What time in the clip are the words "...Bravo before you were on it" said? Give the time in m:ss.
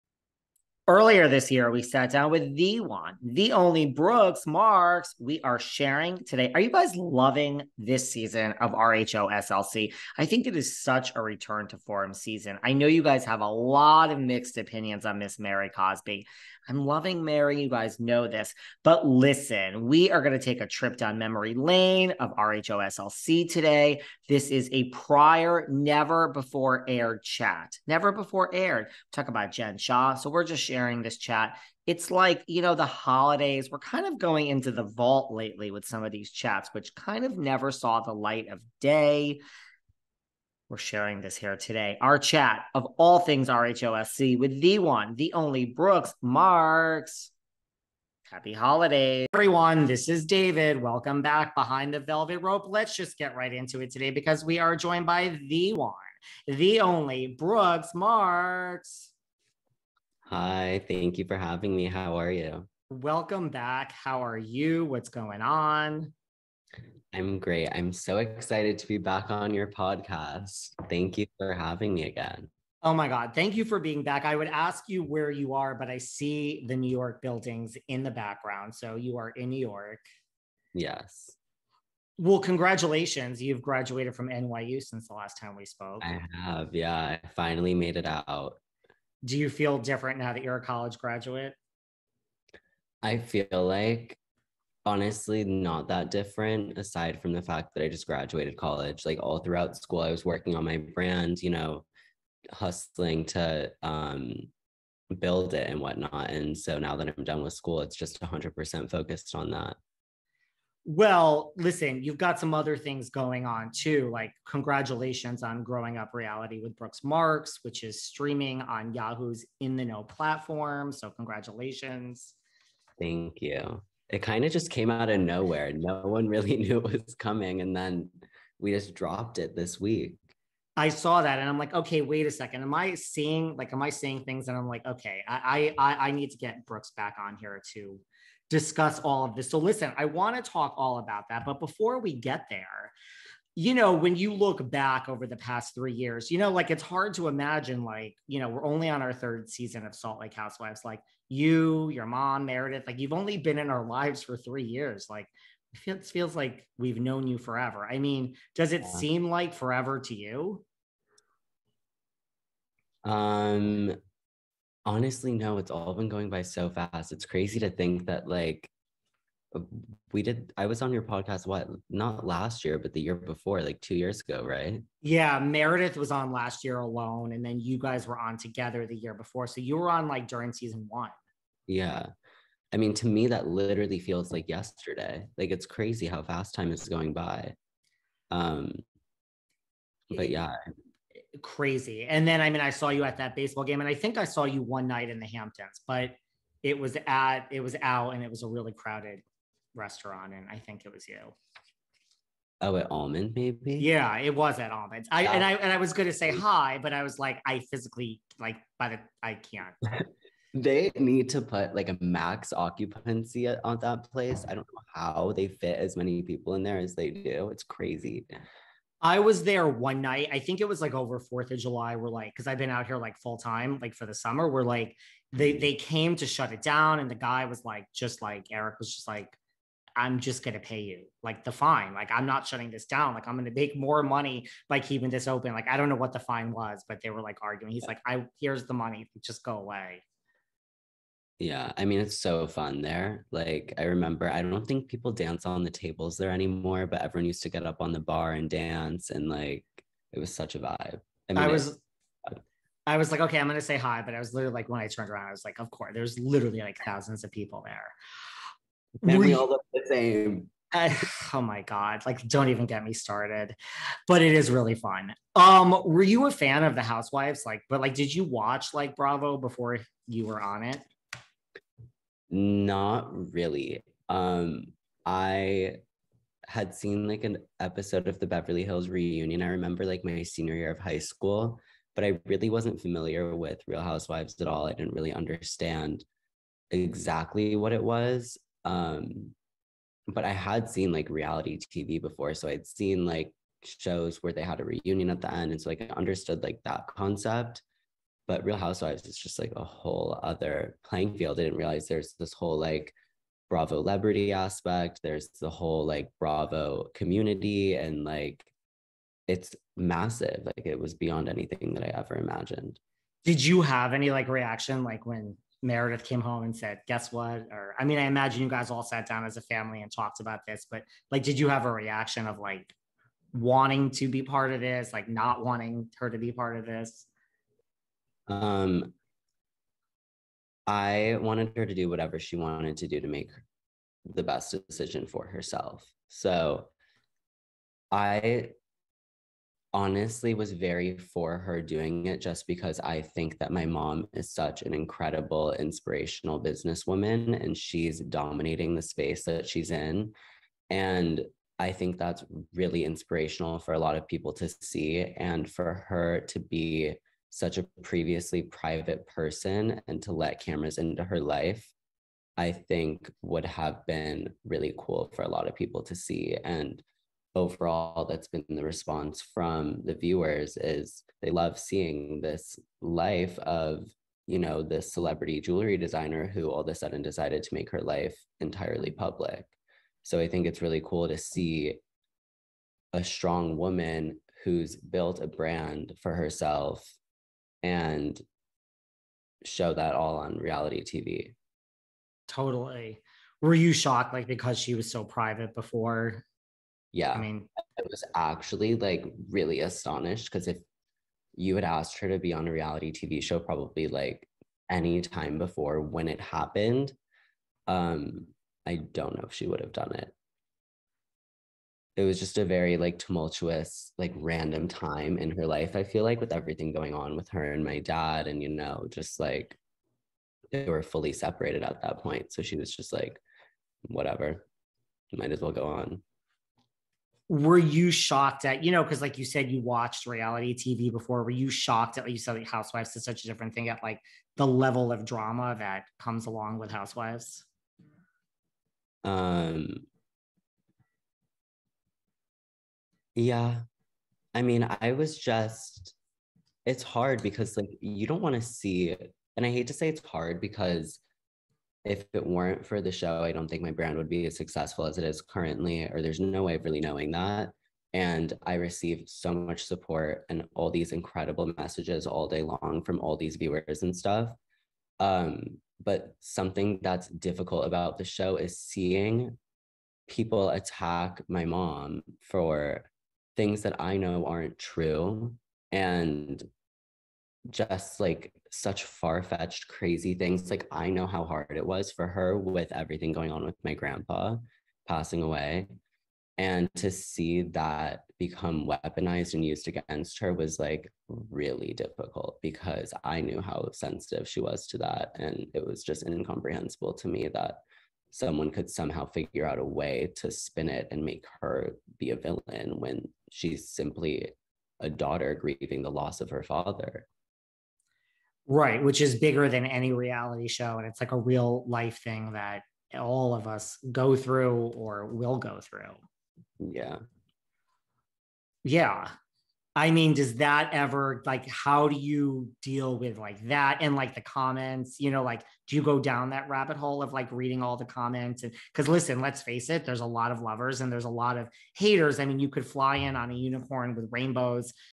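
4:28.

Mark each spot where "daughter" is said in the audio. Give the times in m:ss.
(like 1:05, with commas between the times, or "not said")
8:24.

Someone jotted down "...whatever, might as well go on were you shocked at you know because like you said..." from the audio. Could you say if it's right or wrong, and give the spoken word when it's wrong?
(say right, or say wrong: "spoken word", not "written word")
right.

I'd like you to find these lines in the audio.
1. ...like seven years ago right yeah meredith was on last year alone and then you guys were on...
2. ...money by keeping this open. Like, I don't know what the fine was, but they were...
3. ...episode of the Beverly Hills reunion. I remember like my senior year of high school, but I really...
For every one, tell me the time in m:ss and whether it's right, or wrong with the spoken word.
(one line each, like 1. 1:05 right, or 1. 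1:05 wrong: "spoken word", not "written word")
1. 2:53 wrong: "two", not "seven"
2. 3:54 right
3. 4:37 right.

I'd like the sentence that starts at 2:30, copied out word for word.
Like you, your mom, Meredith, like you've only been in our lives for three years.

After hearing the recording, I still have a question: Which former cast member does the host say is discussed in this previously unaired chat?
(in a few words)
Jen Shah.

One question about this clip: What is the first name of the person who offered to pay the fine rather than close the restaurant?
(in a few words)
Eric.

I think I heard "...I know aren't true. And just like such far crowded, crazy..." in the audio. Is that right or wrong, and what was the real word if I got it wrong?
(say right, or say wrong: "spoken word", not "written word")
wrong: "fetched", not "crowded".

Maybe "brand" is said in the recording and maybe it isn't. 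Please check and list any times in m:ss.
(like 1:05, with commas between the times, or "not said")
1:40, 6:25, 7:33.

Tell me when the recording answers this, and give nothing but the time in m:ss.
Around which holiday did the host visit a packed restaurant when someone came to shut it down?
3:41.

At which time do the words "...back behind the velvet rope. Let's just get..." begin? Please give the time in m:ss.
0:51.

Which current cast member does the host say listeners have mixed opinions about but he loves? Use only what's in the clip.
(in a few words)
Mary Cosby.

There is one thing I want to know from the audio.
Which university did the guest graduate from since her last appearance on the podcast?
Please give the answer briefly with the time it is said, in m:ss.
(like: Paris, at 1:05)
NYU, at 1:24.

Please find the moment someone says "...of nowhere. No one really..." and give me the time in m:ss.
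2:05.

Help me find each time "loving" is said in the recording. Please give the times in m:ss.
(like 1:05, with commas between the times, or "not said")
0:06, 0:16.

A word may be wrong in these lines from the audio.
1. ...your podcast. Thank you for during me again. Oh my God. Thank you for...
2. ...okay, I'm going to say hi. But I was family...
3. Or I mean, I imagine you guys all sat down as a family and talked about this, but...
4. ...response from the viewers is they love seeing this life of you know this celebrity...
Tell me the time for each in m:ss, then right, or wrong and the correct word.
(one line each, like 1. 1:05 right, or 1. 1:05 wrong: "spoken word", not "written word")
1. 1:09 wrong: "having", not "during"
2. 4:13 wrong: "literally", not "family"
3. 5:17 right
4. 6:08 right.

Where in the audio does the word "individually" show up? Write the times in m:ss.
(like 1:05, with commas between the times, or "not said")
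not said.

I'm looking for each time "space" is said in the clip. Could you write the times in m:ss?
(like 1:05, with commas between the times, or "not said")
5:48.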